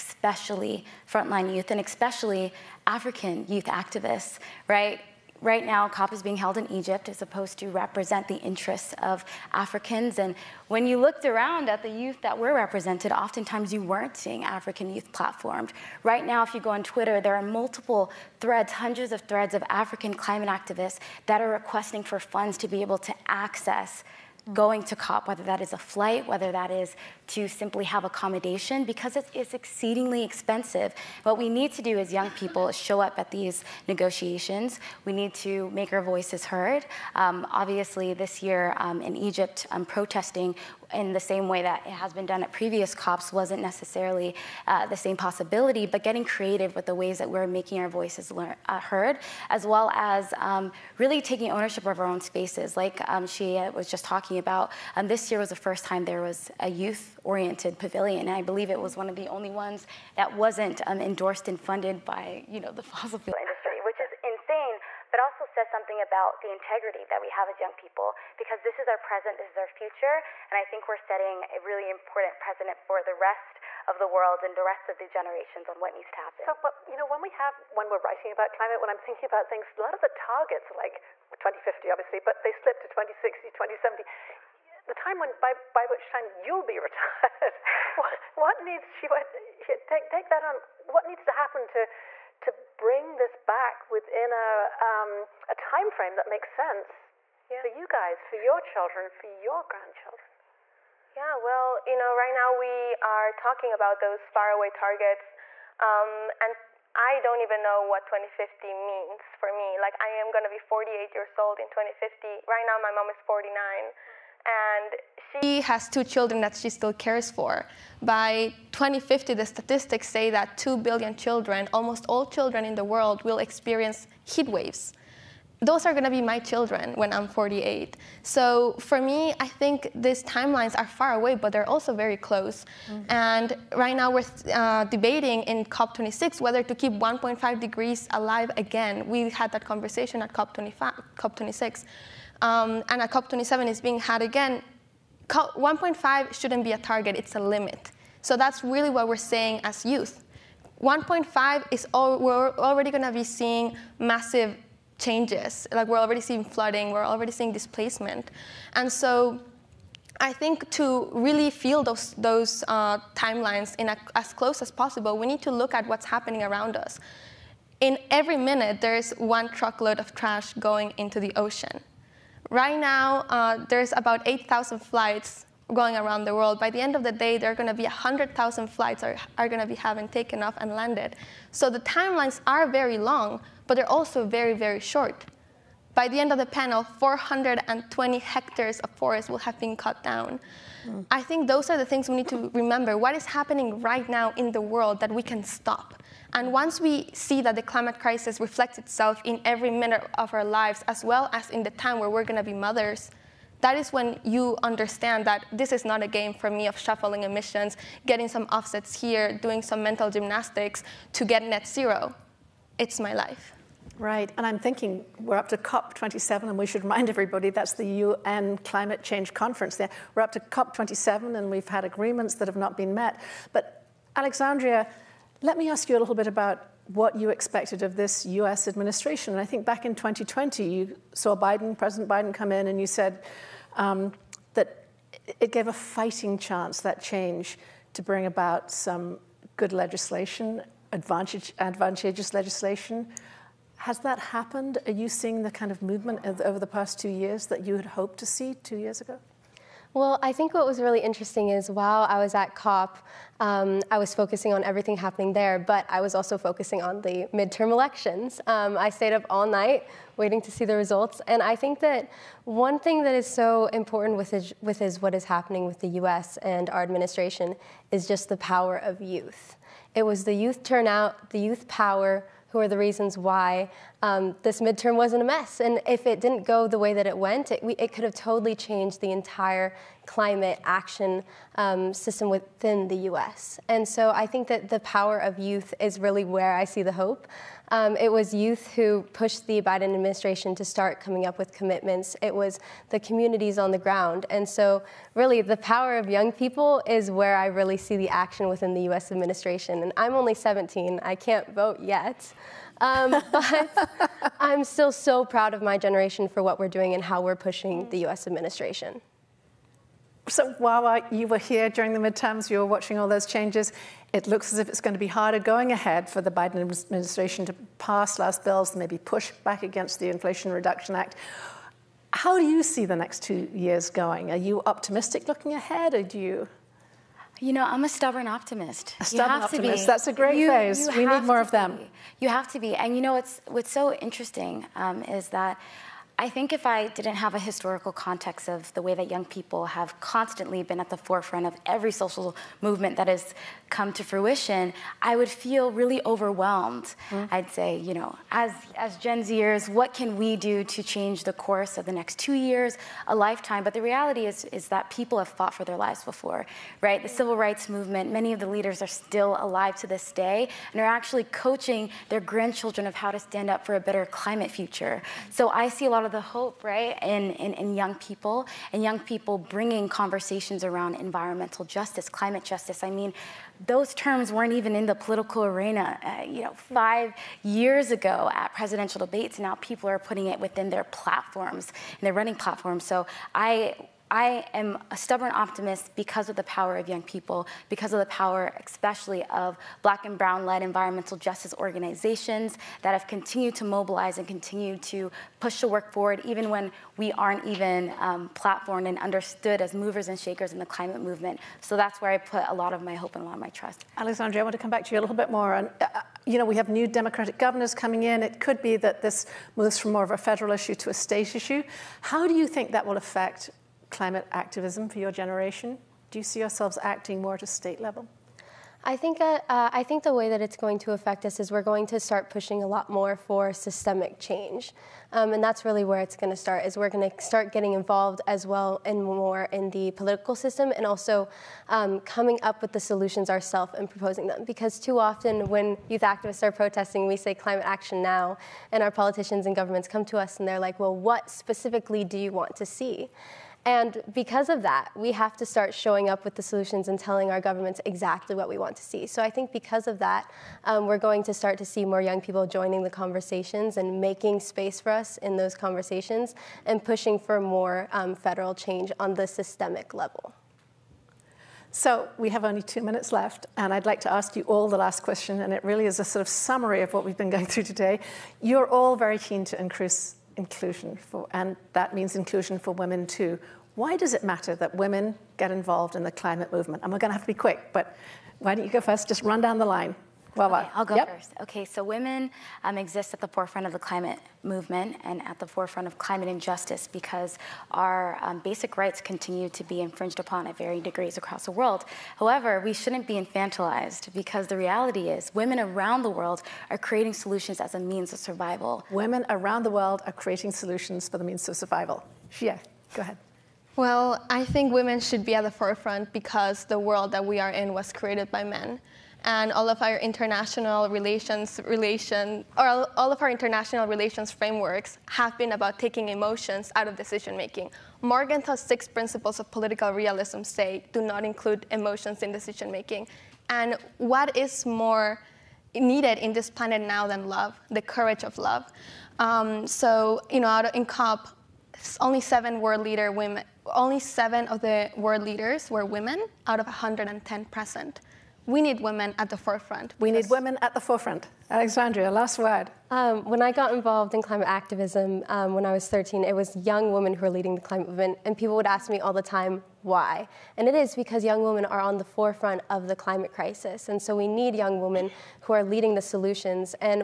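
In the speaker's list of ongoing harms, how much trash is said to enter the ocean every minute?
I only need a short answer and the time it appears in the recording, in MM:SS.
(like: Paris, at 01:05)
one truckload, at 02:49.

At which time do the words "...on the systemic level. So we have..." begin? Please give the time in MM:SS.
07:38.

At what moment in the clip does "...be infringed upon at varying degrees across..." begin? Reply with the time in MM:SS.
08:09.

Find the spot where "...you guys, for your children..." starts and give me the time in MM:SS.
01:37.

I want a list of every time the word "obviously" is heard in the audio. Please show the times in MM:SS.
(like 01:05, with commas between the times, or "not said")
00:37, 01:21.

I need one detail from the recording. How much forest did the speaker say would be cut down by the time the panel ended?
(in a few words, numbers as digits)
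420 hectares.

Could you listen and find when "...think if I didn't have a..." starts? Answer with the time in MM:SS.
05:36.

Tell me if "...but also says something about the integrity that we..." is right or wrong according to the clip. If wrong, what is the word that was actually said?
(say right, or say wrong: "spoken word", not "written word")
right.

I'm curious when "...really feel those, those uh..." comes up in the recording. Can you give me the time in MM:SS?
02:41.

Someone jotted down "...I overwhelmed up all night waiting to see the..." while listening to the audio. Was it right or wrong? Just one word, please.
wrong.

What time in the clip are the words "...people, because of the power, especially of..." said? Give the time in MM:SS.
06:27.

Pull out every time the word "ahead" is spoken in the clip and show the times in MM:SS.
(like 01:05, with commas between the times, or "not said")
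05:15, 05:25, 08:23.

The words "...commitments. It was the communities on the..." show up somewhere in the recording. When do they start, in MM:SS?
04:51.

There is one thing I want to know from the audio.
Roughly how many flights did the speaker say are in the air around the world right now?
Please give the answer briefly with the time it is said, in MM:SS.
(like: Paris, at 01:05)
8,000, at 02:54.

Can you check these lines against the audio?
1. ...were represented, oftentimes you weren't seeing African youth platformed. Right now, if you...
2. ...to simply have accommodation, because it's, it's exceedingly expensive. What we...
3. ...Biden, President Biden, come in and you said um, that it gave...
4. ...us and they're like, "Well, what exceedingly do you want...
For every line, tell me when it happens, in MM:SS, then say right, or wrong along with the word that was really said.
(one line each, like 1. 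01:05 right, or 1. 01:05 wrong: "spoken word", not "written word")
1. 00:12 right
2. 00:27 right
3. 03:51 right
4. 07:20 wrong: "specifically", not "exceedingly".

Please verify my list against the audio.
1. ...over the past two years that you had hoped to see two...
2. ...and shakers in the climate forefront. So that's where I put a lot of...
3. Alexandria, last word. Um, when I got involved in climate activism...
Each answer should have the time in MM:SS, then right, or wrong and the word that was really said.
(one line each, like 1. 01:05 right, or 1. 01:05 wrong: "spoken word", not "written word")
1. 04:06 right
2. 06:40 wrong: "movement", not "forefront"
3. 09:01 right.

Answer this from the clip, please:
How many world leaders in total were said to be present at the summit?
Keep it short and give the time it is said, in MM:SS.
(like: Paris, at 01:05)
110, at 08:56.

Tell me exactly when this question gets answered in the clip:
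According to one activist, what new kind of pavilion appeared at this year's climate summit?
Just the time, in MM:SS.
00:56.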